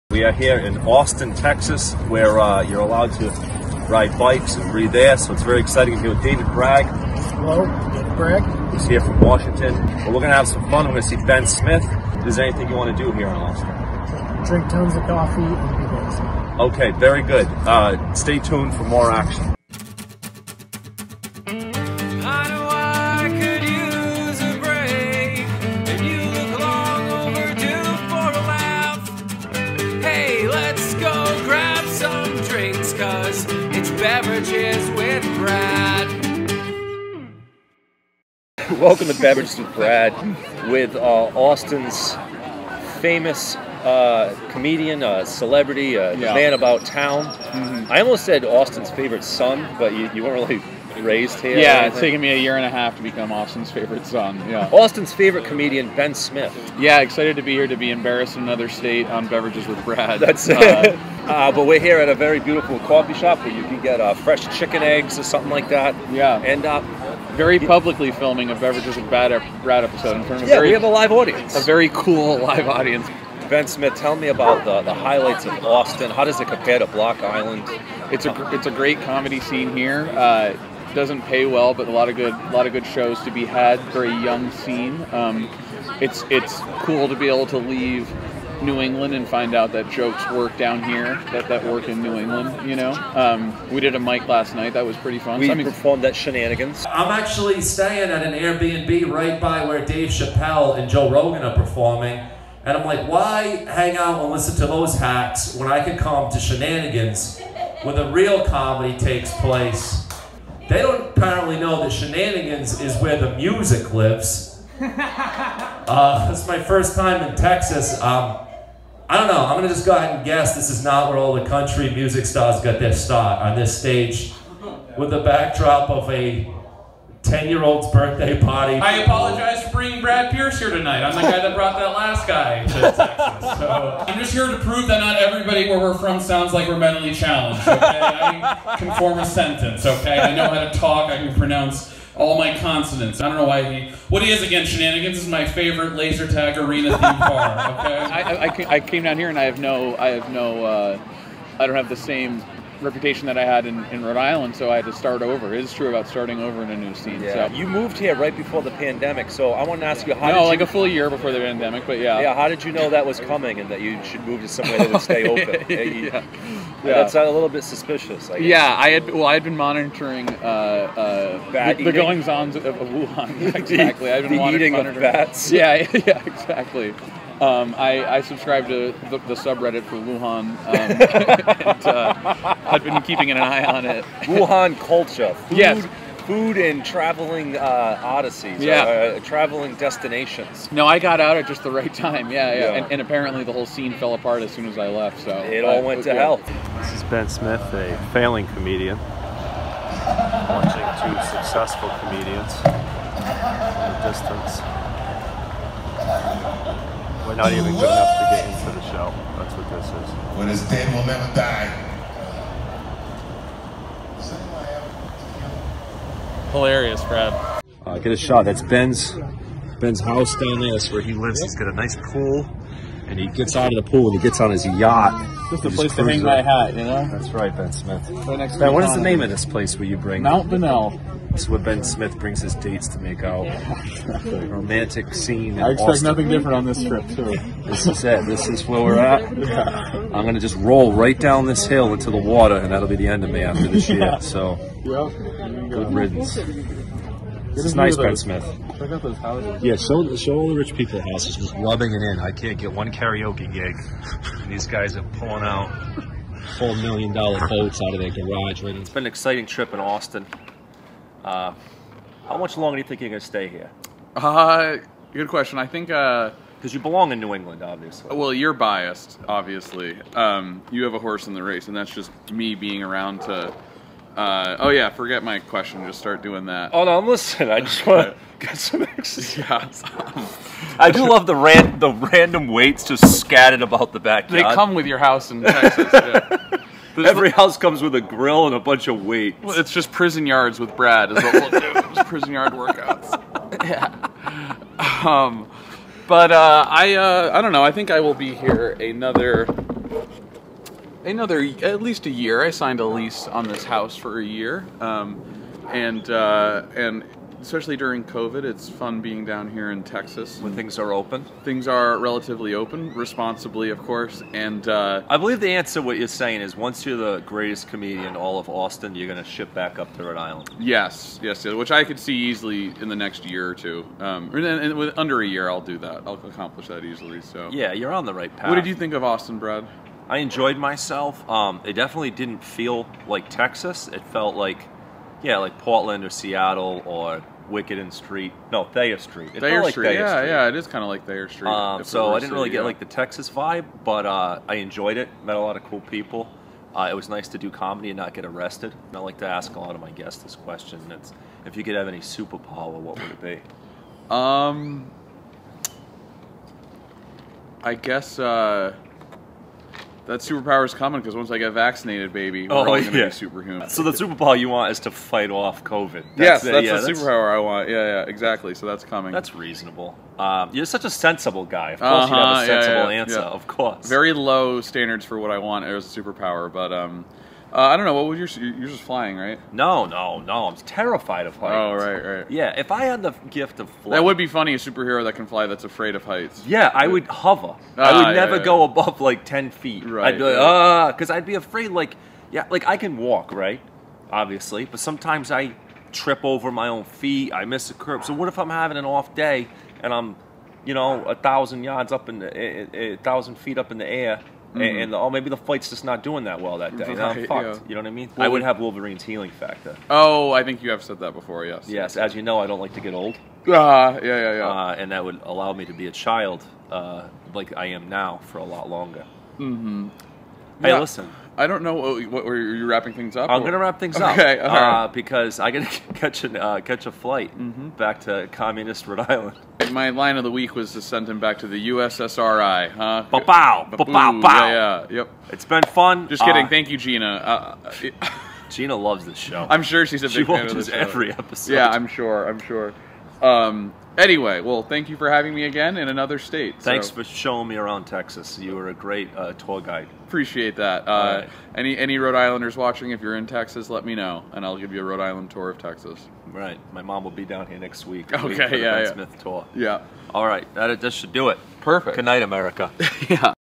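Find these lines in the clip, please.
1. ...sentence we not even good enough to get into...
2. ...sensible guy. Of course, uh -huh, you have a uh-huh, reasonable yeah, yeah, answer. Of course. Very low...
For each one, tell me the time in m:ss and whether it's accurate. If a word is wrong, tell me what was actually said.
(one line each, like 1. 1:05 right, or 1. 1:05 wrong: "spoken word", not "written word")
1. 3:24 wrong: "distance", not "sentence"
2. 6:10 wrong: "sensible", not "reasonable".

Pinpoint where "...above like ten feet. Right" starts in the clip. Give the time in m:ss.
6:28.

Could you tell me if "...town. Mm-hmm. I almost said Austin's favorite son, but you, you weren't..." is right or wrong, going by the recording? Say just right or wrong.
right.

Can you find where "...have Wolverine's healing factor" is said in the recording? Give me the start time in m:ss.
6:48.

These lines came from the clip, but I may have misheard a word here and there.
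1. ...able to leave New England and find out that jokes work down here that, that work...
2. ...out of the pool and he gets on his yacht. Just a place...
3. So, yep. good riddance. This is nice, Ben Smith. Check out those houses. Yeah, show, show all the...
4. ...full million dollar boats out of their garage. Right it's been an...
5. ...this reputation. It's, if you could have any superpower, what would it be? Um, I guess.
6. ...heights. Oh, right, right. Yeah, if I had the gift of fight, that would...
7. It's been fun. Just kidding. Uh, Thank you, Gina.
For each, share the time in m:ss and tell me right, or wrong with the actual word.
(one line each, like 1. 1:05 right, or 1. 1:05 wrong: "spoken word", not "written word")
1. 1:27 right
2. 3:43 right
3. 4:04 right
4. 4:16 right
5. 5:50 wrong: "question", not "reputation"
6. 6:21 wrong: "flight", not "fight"
7. 7:15 right.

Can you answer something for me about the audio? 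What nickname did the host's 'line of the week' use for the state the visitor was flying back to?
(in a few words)
USSRI.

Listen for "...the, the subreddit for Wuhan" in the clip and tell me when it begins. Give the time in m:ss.
2:59.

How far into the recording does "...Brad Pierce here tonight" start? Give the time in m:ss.
2:10.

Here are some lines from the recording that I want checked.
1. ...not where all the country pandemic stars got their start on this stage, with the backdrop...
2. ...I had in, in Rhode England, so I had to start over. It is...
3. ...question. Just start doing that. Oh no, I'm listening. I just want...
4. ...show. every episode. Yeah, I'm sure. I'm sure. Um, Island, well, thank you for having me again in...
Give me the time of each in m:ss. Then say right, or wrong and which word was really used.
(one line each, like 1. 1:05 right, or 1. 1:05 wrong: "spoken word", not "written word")
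1. 2:00 wrong: "music", not "pandemic"
2. 2:33 wrong: "Island", not "England"
3. 4:35 right
4. 7:20 wrong: "Anyway", not "Island".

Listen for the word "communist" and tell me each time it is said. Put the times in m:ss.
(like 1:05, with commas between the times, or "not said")
7:08.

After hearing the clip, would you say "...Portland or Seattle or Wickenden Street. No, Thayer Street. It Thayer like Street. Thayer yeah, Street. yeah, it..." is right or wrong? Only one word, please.
right.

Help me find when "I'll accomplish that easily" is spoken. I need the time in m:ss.
5:26.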